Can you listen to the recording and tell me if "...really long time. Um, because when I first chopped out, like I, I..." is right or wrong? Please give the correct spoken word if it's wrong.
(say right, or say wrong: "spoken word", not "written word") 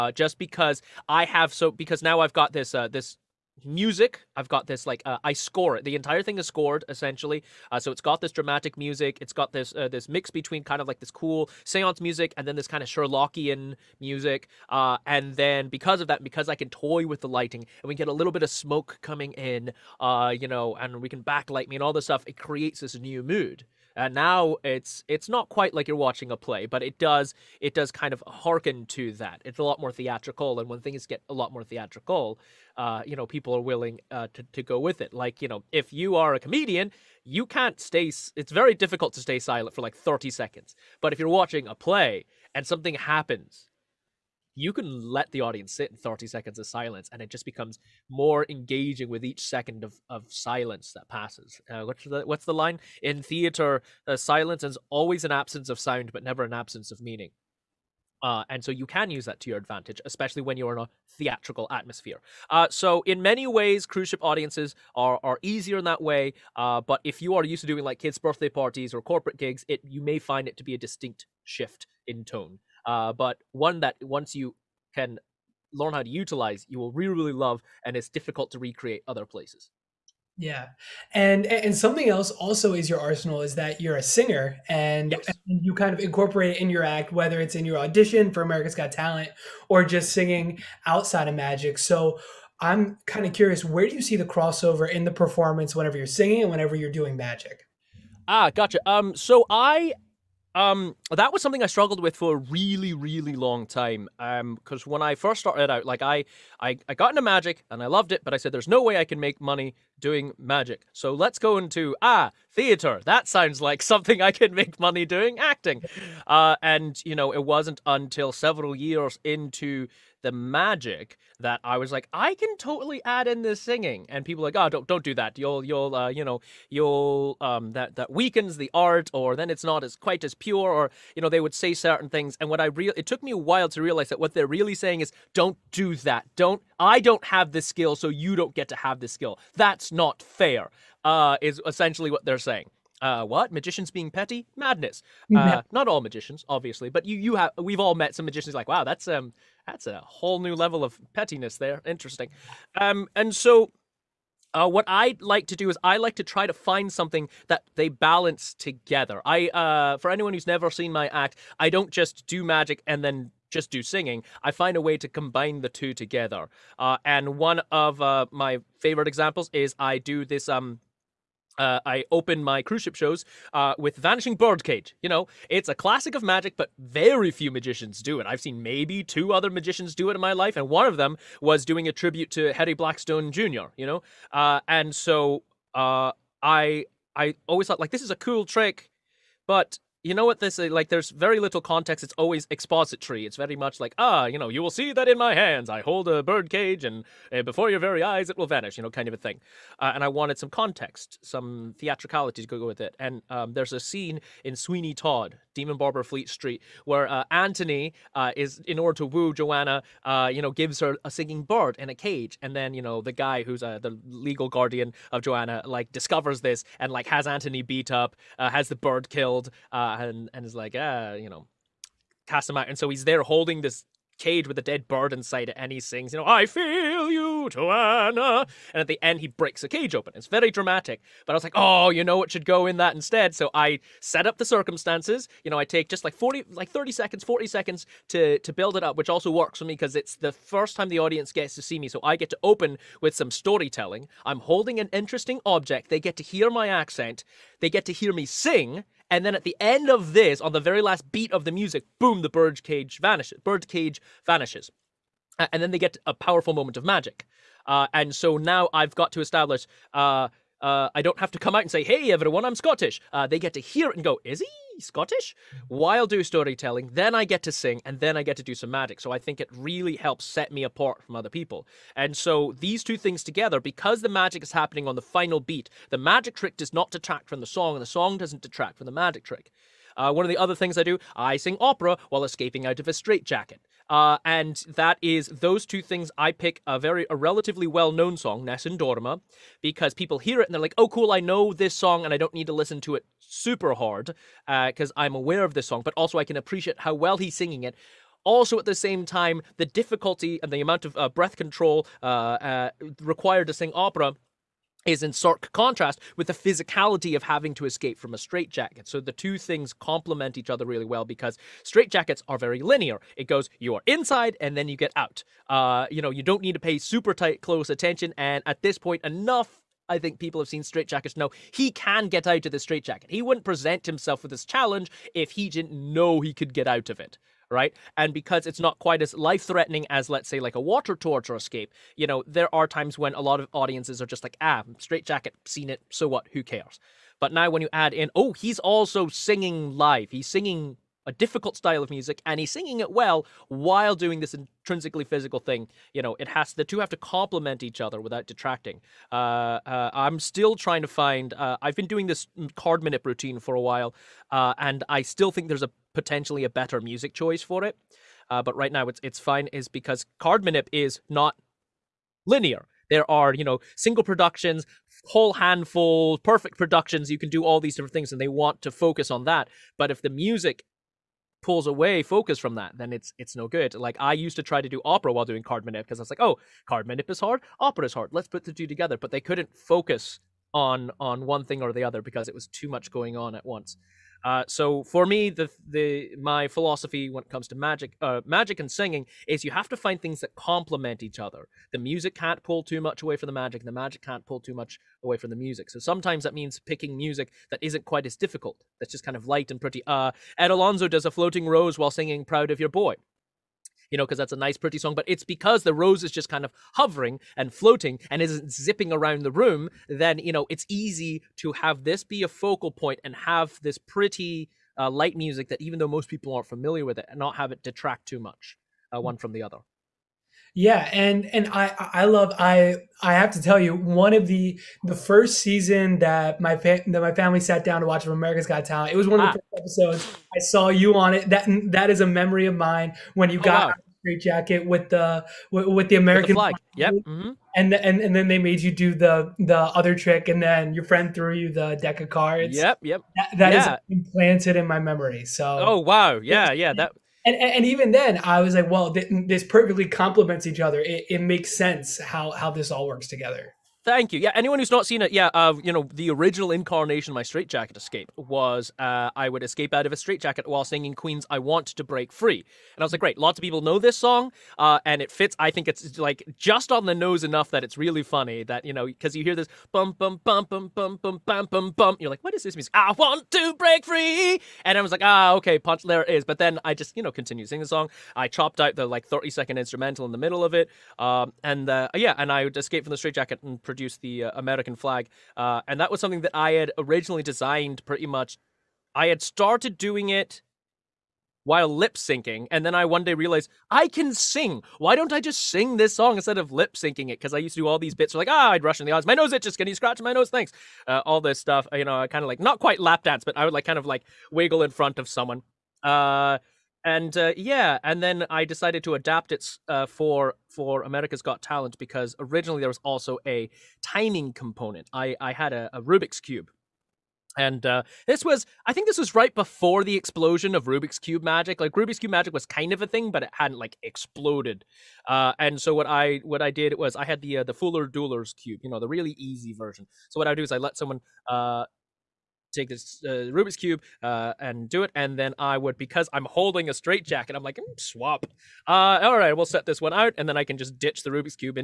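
wrong: "started", not "chopped".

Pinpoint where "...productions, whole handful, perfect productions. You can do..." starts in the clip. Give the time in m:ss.
6:04.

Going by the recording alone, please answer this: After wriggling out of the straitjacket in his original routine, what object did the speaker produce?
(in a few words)
American flag.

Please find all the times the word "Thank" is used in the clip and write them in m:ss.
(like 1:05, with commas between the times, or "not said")
7:33, 8:20.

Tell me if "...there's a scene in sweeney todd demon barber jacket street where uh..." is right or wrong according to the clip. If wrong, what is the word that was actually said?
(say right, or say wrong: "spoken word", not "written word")
wrong: "fleet", not "jacket".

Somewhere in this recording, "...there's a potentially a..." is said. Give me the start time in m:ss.
5:55.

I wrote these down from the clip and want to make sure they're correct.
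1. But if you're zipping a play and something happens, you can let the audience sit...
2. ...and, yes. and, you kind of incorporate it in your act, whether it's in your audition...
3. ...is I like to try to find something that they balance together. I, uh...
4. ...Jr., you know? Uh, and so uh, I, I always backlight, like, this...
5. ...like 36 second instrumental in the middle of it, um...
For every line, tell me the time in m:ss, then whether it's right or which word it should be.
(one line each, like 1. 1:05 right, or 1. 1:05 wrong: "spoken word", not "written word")
1. 0:40 wrong: "watching", not "zipping"
2. 1:24 right
3. 2:35 right
4. 3:03 wrong: "thought", not "backlight"
5. 7:58 wrong: "30", not "36".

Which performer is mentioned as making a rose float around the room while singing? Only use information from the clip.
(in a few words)
Ed Alonzo.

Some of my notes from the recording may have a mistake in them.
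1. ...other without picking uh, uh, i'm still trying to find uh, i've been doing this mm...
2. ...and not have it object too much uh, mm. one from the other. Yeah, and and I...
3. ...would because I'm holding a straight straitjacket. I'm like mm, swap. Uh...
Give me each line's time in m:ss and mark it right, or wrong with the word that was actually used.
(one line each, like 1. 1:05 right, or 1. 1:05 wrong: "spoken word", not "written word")
1. 5:47 wrong: "detracting", not "picking"
2. 6:57 wrong: "detract", not "object"
3. 8:55 wrong: "jacket", not "straitjacket".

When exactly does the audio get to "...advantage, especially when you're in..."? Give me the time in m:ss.
0:59.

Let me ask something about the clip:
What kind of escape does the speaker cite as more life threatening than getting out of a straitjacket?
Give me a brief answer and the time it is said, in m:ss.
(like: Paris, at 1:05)
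Water torture escape, at 5:30.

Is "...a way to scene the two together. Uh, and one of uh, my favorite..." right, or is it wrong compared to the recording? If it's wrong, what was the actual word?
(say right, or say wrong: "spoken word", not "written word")
wrong: "combine", not "scene".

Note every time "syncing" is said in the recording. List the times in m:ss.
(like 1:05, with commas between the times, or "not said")
8:11, 8:16.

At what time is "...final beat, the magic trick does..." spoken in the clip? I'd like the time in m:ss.
4:35.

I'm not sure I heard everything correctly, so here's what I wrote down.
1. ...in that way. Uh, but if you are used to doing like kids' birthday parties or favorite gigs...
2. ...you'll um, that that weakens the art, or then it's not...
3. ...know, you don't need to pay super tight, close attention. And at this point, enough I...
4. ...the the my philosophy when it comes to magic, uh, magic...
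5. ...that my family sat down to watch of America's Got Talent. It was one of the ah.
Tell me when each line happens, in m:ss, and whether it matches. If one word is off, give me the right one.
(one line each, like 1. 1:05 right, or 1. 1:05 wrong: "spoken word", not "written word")
1. 1:05 wrong: "corporate", not "favorite"
2. 2:06 right
3. 5:15 right
4. 6:25 right
5. 7:06 right.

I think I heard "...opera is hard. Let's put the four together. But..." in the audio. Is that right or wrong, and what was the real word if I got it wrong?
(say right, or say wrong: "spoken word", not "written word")
wrong: "two", not "four".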